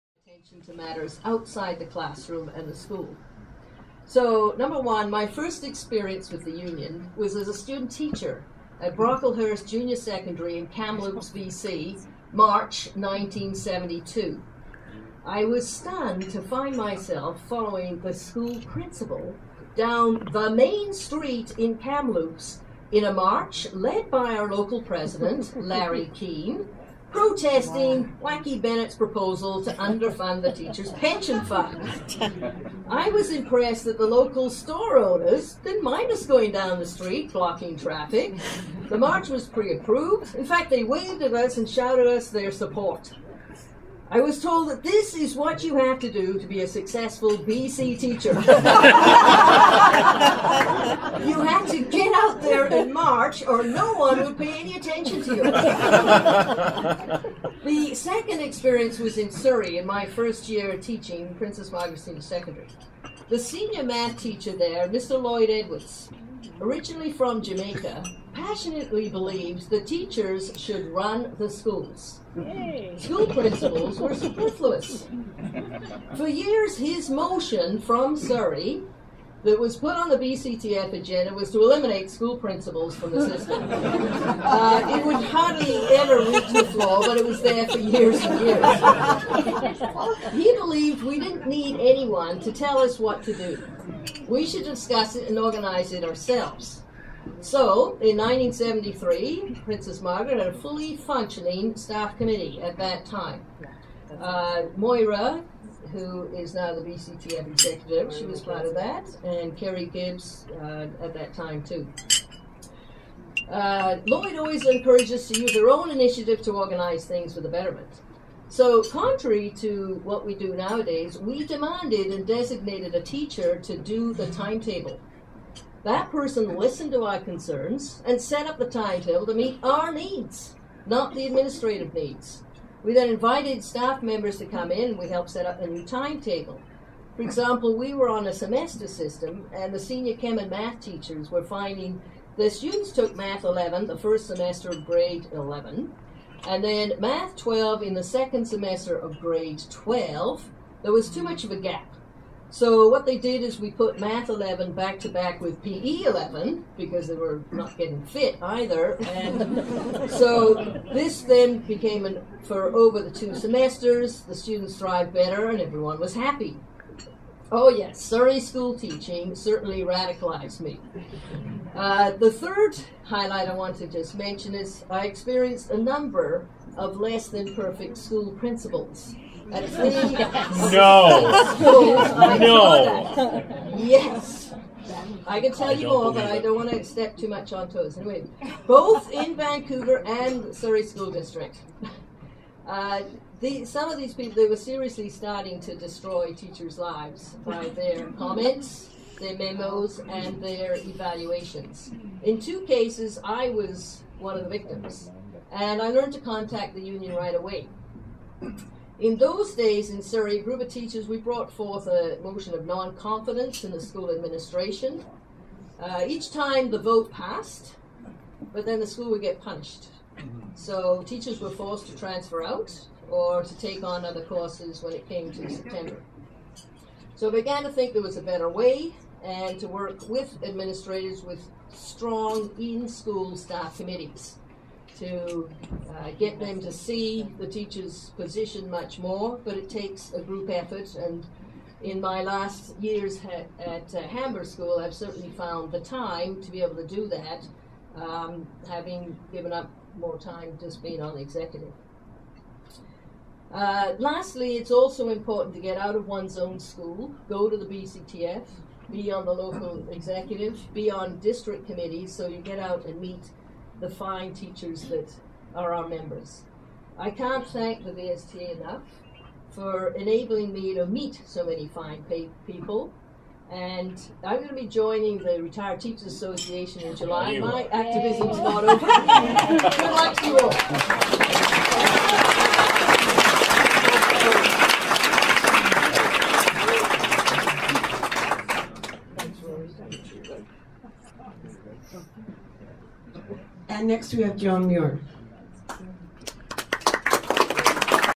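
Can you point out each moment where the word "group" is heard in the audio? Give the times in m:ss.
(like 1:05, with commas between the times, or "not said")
3:30, 4:00.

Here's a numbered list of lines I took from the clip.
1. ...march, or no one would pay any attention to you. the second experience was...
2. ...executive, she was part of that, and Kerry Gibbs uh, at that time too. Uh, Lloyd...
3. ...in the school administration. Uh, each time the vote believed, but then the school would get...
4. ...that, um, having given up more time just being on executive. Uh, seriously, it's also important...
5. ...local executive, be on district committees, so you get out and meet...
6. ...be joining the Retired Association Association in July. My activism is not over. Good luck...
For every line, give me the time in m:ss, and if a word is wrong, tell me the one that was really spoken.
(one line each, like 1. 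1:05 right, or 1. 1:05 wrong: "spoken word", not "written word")
1. 0:52 right
2. 1:47 right
3. 3:33 wrong: "passed", not "believed"
4. 4:07 wrong: "lastly", not "seriously"
5. 4:19 right
6. 4:34 wrong: "Teachers", not "Association".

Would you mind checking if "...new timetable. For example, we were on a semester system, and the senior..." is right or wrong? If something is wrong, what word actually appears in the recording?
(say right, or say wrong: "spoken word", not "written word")
right.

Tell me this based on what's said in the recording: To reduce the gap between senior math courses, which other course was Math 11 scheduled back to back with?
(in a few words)
PE 11.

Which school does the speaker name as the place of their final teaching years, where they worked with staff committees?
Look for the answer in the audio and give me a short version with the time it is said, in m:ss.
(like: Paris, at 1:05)
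Hamber School, at 4:04.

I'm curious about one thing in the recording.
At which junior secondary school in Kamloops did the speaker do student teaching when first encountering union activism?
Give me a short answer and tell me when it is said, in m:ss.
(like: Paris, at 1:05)
Brocklehurst Junior Secondary, at 0:08.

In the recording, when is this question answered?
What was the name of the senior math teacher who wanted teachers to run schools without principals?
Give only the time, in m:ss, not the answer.
1:05.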